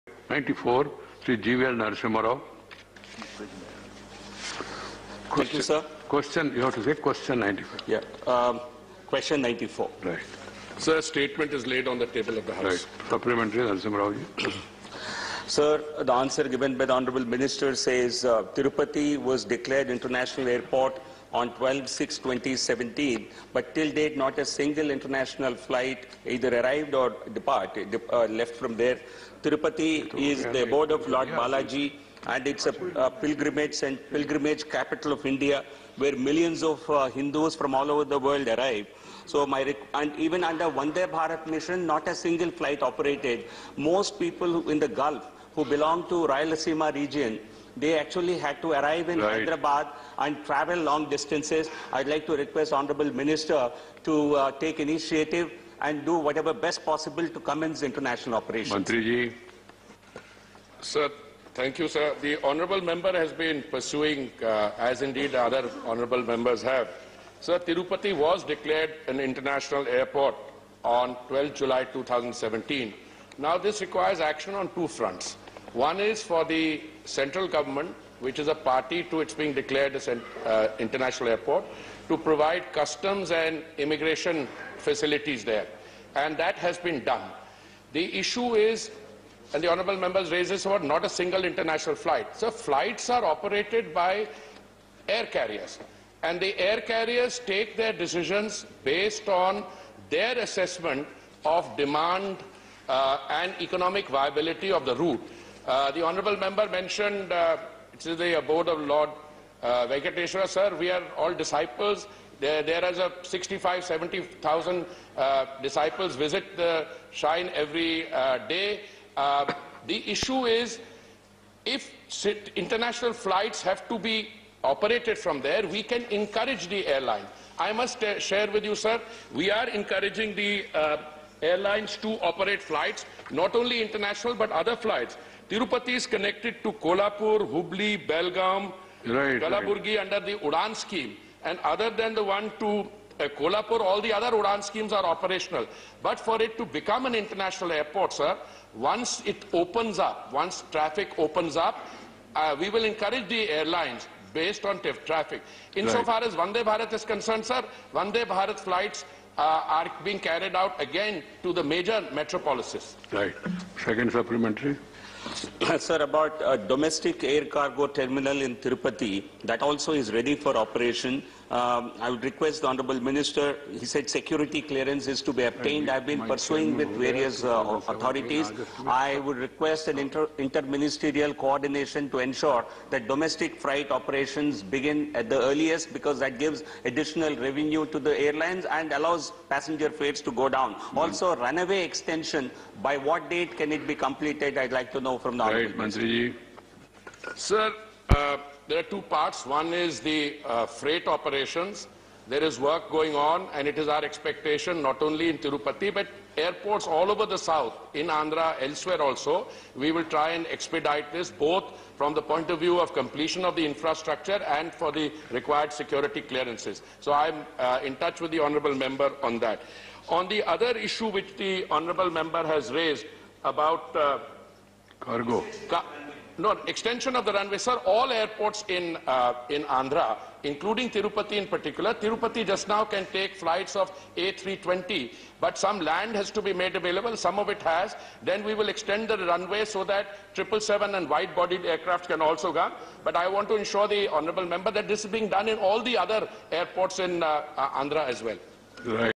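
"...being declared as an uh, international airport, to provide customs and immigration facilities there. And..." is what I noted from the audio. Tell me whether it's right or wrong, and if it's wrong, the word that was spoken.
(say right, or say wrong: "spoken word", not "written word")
right.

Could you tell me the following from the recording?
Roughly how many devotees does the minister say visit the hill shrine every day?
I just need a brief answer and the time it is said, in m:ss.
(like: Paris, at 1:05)
65,000-70,000, at 1:53.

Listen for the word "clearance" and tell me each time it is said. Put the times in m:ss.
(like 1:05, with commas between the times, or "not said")
2:54, 3:36.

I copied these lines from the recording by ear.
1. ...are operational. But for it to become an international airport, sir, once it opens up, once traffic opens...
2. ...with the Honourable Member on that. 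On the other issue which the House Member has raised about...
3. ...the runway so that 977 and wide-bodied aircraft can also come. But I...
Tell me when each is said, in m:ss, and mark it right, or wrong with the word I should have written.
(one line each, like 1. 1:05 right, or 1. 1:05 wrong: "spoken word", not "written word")
1. 2:24 right
2. 3:38 wrong: "Honourable", not "House"
3. 3:59 wrong: "777", not "977".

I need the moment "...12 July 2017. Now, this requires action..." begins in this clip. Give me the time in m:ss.
1:11.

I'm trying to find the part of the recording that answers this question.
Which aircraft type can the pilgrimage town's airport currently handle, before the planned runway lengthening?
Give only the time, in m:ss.
3:54.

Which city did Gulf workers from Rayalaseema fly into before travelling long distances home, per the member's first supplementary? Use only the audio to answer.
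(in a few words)
Hyderabad.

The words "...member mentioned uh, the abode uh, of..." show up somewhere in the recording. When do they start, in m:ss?
1:46.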